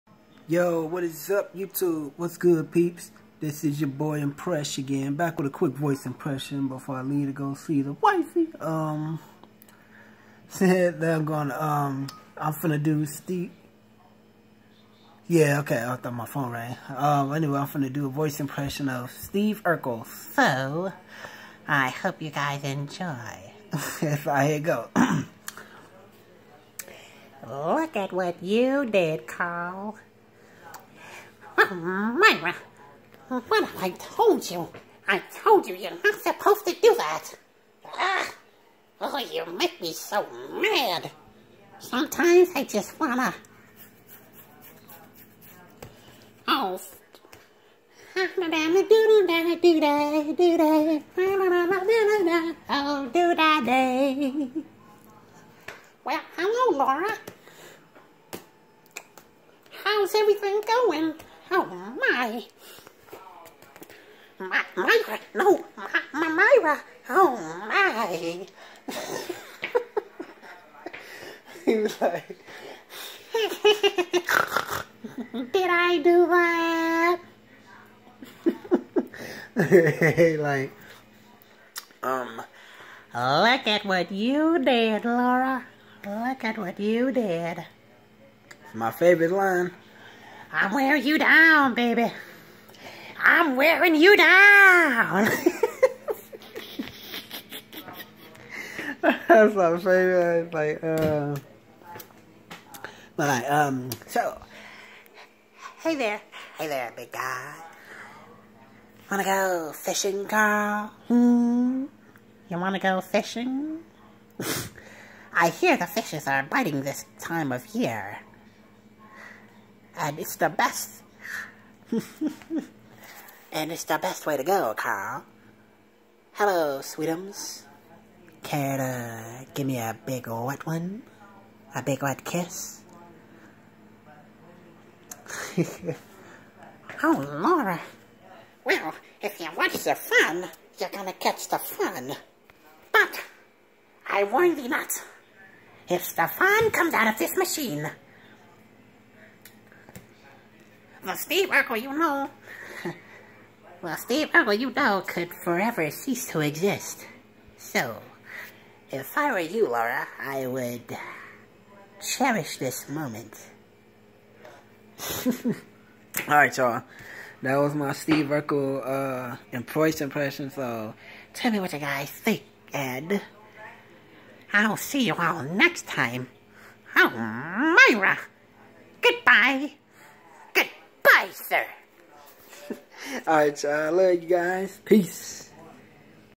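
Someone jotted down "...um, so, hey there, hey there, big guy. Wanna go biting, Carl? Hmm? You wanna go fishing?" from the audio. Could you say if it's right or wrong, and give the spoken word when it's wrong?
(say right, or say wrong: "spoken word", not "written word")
wrong: "fishing", not "biting".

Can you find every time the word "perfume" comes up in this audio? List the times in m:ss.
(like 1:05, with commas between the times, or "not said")
not said.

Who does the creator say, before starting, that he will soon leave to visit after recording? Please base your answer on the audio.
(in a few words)
the wifey.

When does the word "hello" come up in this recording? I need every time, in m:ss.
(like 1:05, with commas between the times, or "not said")
0:56, 2:06.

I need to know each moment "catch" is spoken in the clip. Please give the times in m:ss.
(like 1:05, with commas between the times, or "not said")
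2:21.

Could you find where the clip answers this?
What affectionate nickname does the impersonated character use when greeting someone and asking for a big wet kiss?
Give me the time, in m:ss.
2:06.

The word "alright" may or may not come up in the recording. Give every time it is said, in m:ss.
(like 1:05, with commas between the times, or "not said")
2:46, 3:03.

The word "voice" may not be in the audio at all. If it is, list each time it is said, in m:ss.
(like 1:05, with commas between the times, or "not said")
0:05, 0:18.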